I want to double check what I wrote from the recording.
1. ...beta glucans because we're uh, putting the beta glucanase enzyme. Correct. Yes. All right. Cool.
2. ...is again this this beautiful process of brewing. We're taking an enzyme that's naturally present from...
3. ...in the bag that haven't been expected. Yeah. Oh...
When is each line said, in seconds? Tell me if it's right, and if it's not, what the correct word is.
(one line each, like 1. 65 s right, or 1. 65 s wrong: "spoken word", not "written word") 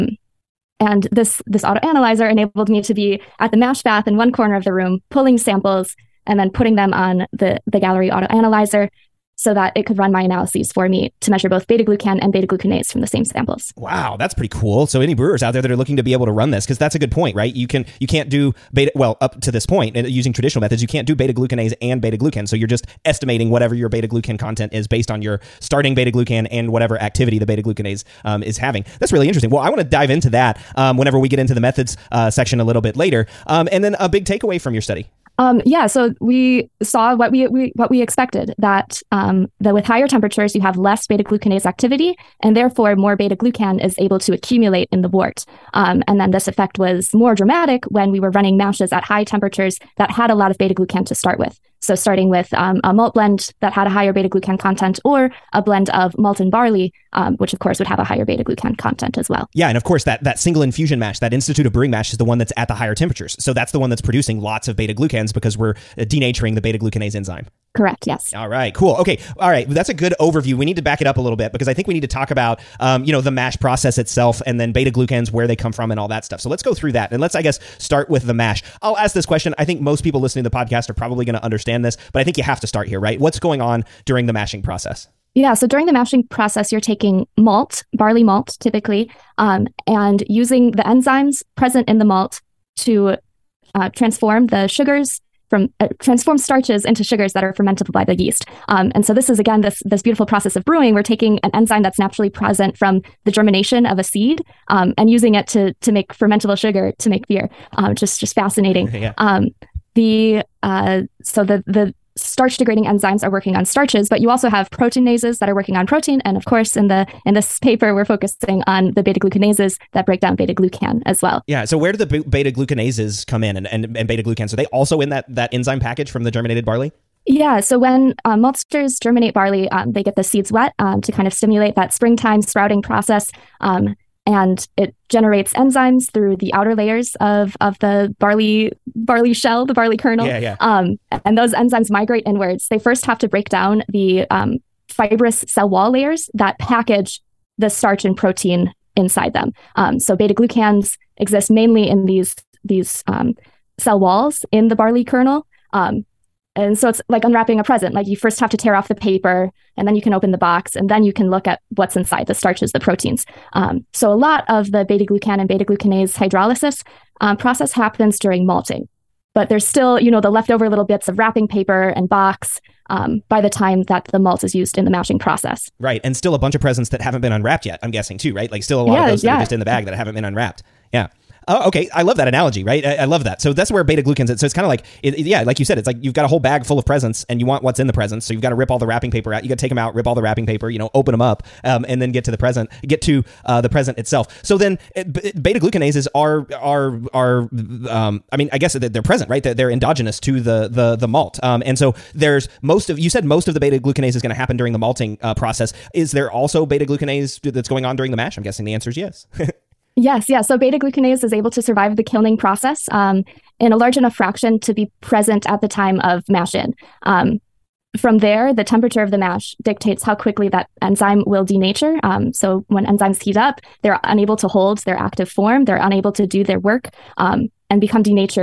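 1. 64 s wrong: "denaturing", not "putting"
2. 99 s right
3. 179 s wrong: "unwrapped", not "expected".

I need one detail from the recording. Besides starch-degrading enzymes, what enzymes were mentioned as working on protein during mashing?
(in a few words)
Proteinases.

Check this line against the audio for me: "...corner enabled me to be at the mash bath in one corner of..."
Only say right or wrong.
wrong.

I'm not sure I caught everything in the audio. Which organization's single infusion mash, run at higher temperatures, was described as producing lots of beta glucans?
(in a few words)
Institute of Brewing.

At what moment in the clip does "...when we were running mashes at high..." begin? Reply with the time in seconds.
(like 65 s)
47 s.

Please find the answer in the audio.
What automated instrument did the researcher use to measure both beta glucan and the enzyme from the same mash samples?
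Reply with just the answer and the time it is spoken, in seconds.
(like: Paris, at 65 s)
Gallery auto analyzer, at 7 s.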